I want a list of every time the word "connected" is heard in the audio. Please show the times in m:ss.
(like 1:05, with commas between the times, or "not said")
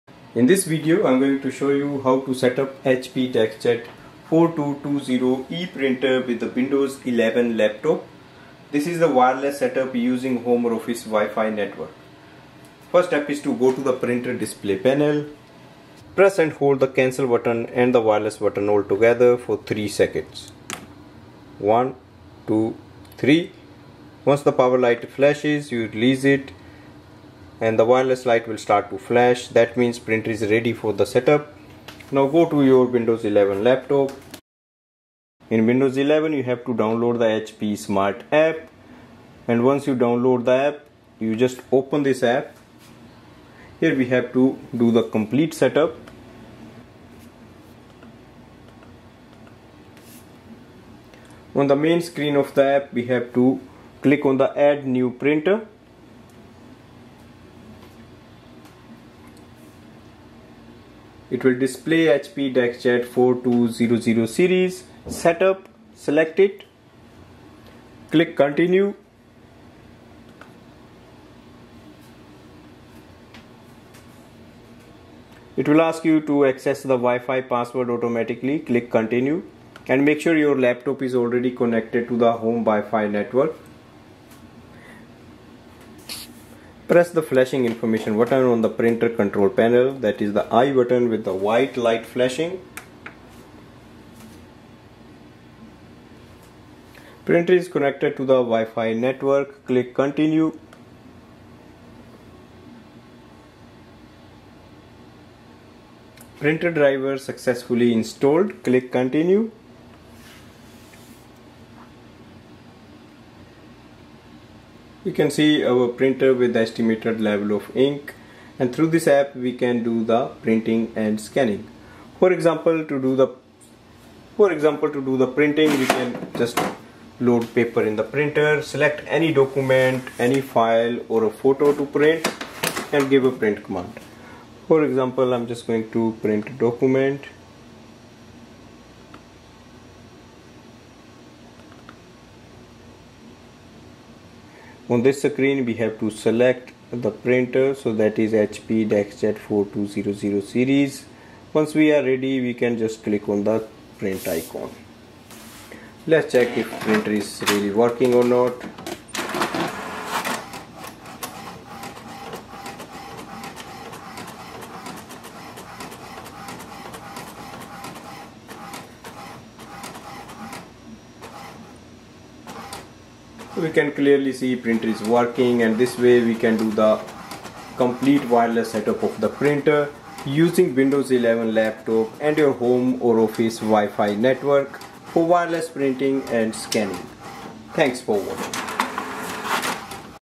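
1:21, 1:37.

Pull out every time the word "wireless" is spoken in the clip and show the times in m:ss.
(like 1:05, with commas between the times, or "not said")
0:09, 0:17, 0:27, 2:58, 3:05.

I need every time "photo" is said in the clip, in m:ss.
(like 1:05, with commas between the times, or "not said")
2:11.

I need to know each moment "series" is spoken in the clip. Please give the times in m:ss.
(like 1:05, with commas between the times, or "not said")
1:04, 2:30.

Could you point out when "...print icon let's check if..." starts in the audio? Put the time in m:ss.
2:33.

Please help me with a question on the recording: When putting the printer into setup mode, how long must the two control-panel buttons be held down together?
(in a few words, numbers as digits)
3 seconds.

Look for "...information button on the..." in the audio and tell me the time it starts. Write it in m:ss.
1:27.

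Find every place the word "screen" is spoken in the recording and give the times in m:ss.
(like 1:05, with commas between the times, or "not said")
0:52, 2:25.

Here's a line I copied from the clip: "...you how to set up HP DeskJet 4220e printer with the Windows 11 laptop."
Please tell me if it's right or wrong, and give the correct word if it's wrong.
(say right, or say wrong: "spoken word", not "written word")
right.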